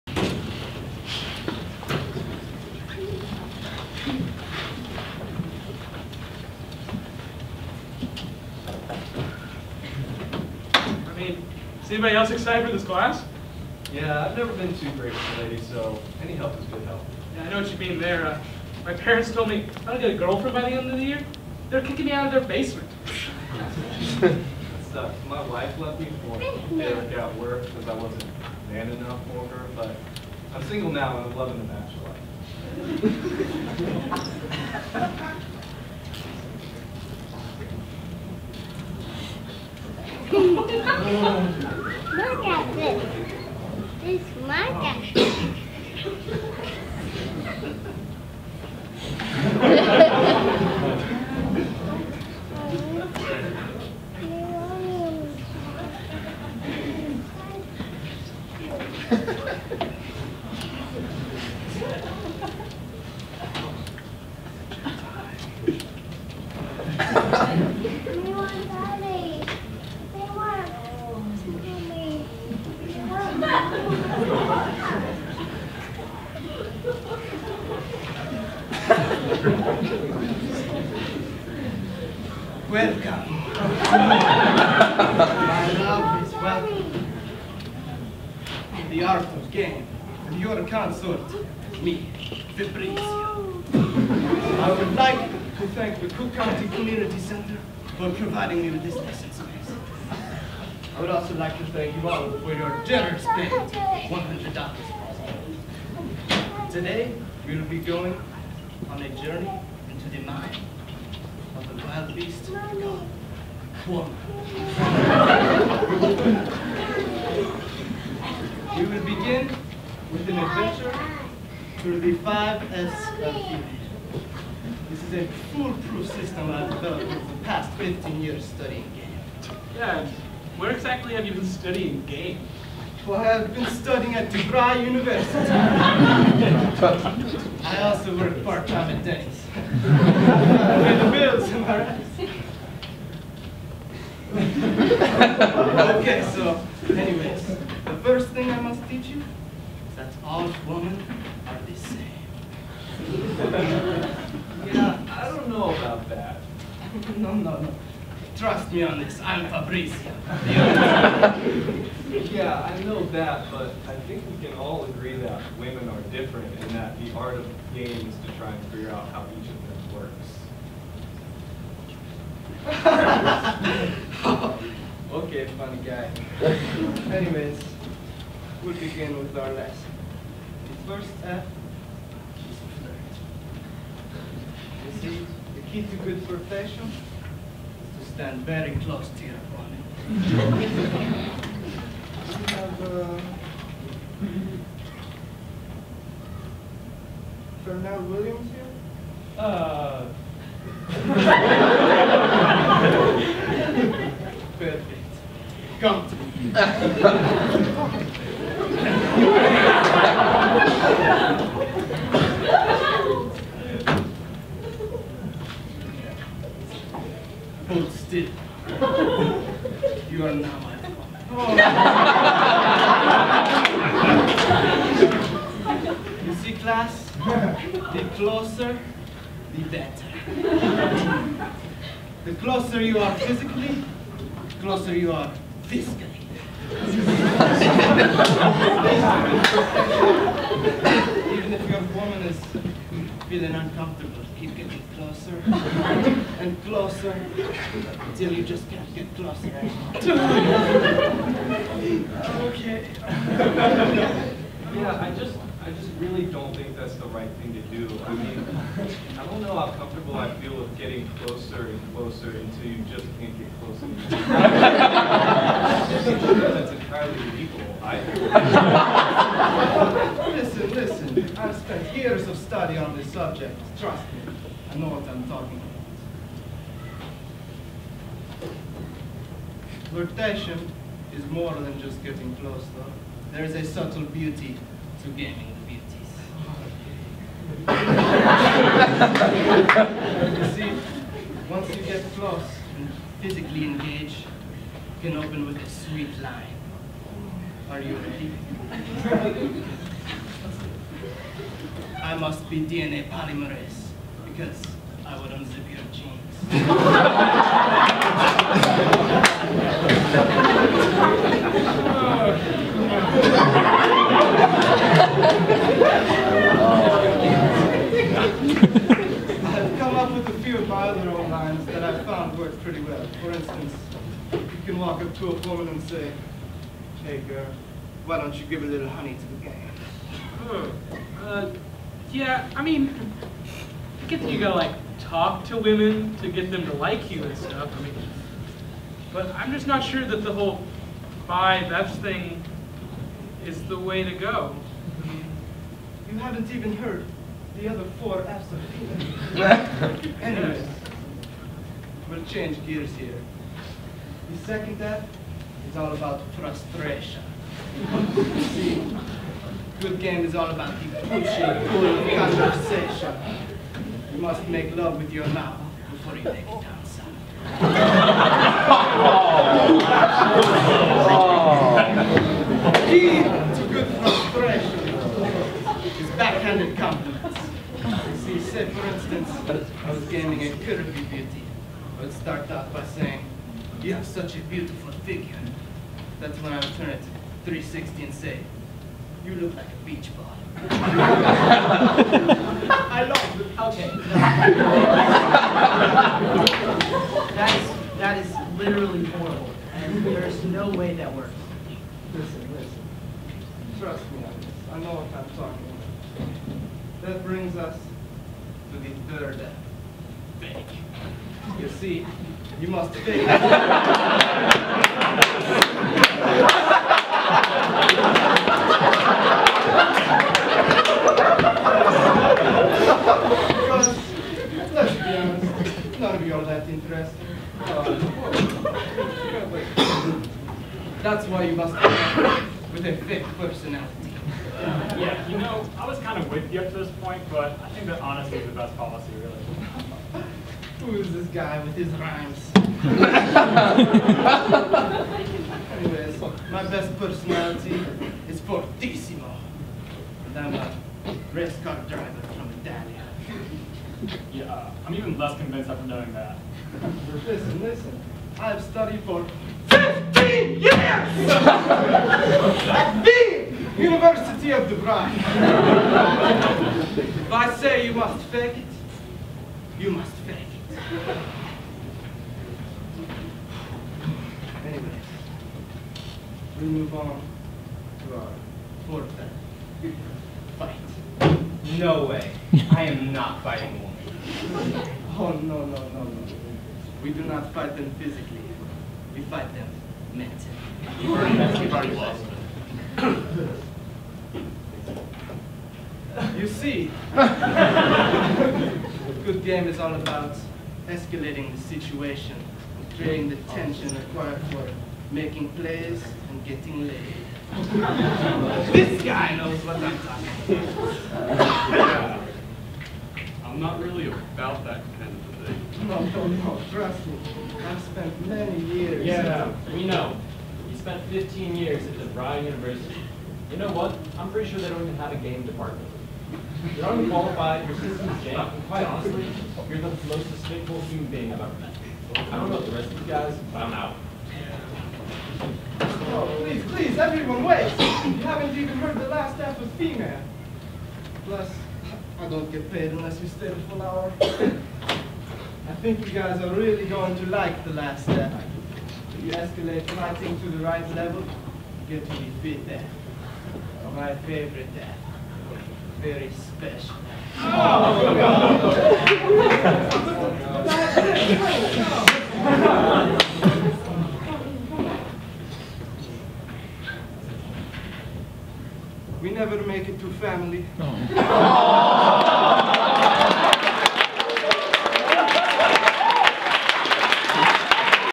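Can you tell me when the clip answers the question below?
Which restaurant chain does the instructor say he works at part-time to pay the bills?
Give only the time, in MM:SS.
02:19.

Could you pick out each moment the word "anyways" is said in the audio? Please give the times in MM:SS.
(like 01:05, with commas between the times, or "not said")
02:26, 02:57, 05:50, 07:25, 07:54.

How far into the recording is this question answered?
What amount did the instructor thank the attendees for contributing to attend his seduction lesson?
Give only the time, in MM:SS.
01:43.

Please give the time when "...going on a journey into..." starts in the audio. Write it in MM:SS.
01:47.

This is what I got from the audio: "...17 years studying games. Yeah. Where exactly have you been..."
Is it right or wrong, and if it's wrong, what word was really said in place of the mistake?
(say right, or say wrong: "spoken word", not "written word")
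wrong: "15", not "17".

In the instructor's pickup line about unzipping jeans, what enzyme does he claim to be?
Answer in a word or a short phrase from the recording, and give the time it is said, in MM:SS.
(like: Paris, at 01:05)
DNA polymerase, at 05:02.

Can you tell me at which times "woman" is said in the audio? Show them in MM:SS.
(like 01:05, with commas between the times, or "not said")
04:01, 05:25, 08:03.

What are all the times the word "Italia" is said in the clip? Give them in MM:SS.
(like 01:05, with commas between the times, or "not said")
07:32.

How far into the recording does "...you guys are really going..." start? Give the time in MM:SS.
09:06.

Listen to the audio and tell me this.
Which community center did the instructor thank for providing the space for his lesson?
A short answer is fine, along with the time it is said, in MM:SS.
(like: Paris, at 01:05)
Cook County Community Center, at 01:36.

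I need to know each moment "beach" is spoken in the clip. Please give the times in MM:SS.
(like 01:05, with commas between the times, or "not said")
06:29.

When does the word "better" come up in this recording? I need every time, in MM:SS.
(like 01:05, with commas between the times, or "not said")
03:49.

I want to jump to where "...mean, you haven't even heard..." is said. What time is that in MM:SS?
05:45.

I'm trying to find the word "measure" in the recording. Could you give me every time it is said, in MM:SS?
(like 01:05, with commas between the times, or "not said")
not said.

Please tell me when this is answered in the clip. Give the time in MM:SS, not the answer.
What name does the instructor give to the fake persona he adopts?
07:28.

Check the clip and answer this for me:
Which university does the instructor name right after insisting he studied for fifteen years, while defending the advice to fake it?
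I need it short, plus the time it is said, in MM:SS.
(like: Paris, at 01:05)
University of Dubai, at 07:43.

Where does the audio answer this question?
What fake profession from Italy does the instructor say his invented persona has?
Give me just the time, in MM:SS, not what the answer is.
07:31.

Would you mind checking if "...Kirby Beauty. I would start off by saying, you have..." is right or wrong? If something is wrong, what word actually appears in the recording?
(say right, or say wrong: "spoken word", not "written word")
right.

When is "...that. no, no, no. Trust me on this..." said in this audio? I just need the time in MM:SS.
02:36.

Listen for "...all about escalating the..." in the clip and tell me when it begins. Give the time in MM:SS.
08:19.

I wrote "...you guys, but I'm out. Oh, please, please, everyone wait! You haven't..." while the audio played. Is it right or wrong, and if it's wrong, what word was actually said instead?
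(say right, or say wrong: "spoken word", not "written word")
right.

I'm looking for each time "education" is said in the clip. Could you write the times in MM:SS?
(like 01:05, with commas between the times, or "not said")
not said.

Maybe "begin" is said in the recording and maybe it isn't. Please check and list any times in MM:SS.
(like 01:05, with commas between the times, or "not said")
01:59, 02:58.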